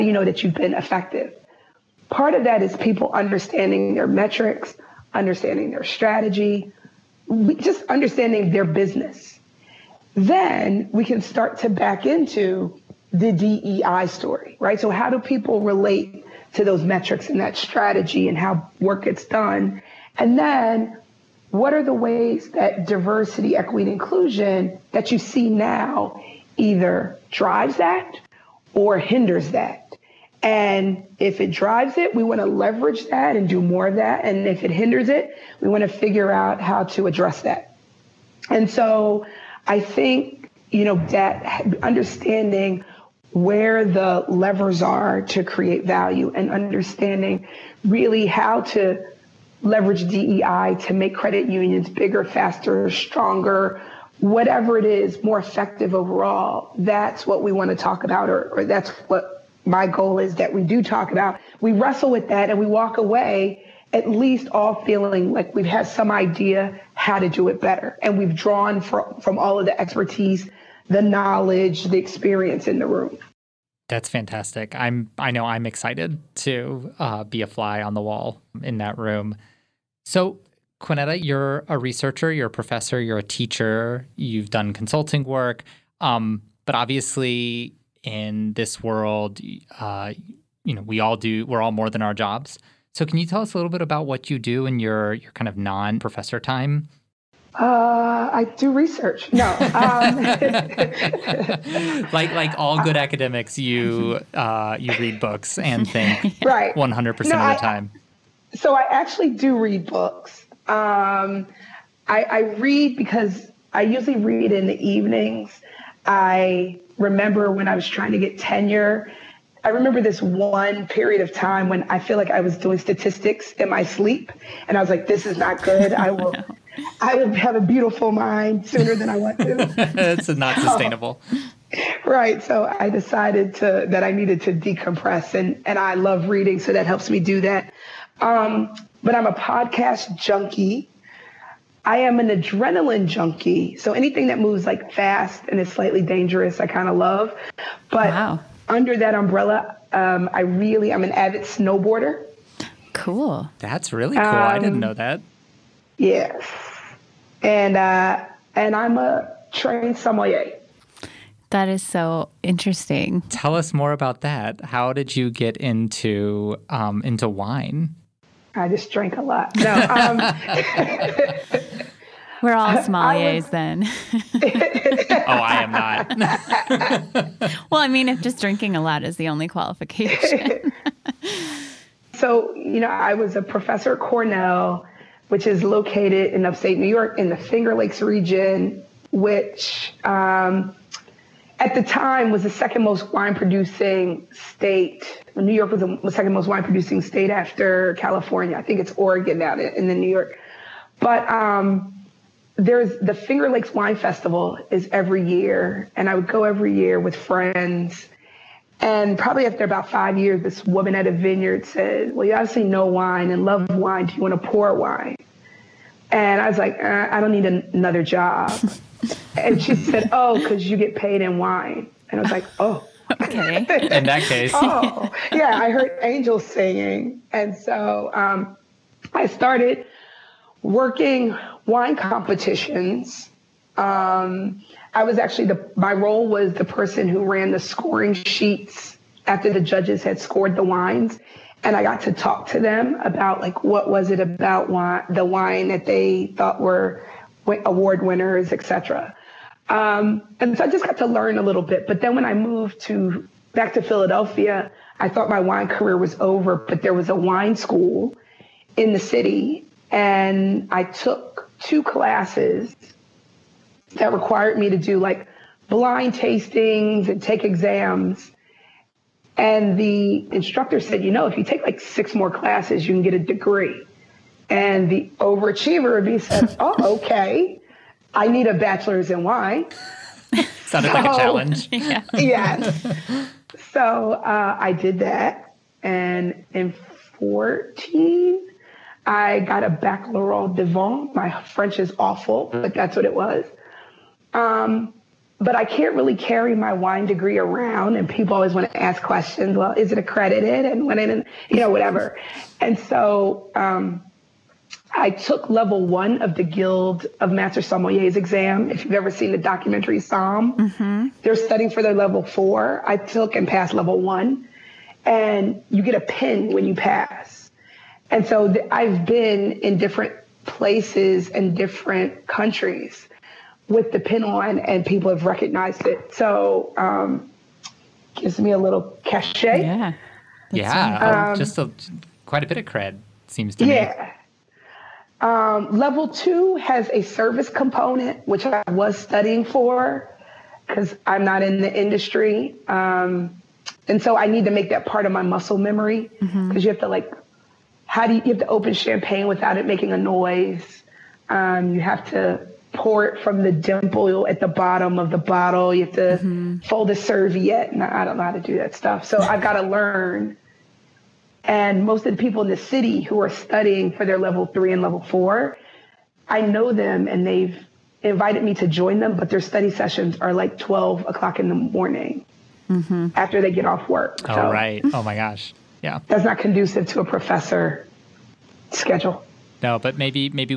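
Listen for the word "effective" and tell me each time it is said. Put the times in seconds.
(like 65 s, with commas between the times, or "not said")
0 s, 55 s.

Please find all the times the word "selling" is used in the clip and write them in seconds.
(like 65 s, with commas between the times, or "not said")
not said.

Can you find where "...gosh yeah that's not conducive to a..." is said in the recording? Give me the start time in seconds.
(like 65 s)
375 s.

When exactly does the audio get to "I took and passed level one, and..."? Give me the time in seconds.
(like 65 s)
312 s.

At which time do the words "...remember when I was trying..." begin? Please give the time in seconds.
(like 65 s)
116 s.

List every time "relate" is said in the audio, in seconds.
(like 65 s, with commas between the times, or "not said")
15 s.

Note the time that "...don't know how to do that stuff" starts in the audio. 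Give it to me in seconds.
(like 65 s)
358 s.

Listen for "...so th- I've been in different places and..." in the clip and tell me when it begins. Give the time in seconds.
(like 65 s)
318 s.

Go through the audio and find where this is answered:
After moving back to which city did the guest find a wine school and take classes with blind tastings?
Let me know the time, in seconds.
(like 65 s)
253 s.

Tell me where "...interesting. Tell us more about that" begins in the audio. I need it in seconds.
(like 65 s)
162 s.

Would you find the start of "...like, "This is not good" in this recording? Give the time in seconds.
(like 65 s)
124 s.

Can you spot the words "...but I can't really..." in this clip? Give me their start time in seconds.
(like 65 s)
295 s.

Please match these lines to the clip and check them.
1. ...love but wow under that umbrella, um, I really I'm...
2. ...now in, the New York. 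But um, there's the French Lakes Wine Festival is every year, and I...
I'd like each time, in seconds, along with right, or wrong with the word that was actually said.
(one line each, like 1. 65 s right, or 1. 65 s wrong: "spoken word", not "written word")
1. 146 s right
2. 199 s wrong: "Finger", not "French".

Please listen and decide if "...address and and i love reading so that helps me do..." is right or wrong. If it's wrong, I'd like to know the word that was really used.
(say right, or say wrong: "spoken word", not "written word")
wrong: "decompress", not "address".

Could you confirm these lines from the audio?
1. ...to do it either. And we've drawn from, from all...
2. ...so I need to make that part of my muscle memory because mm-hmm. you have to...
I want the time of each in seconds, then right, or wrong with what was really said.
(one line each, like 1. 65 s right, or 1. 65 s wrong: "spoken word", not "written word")
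1. 67 s wrong: "better", not "either"
2. 344 s right.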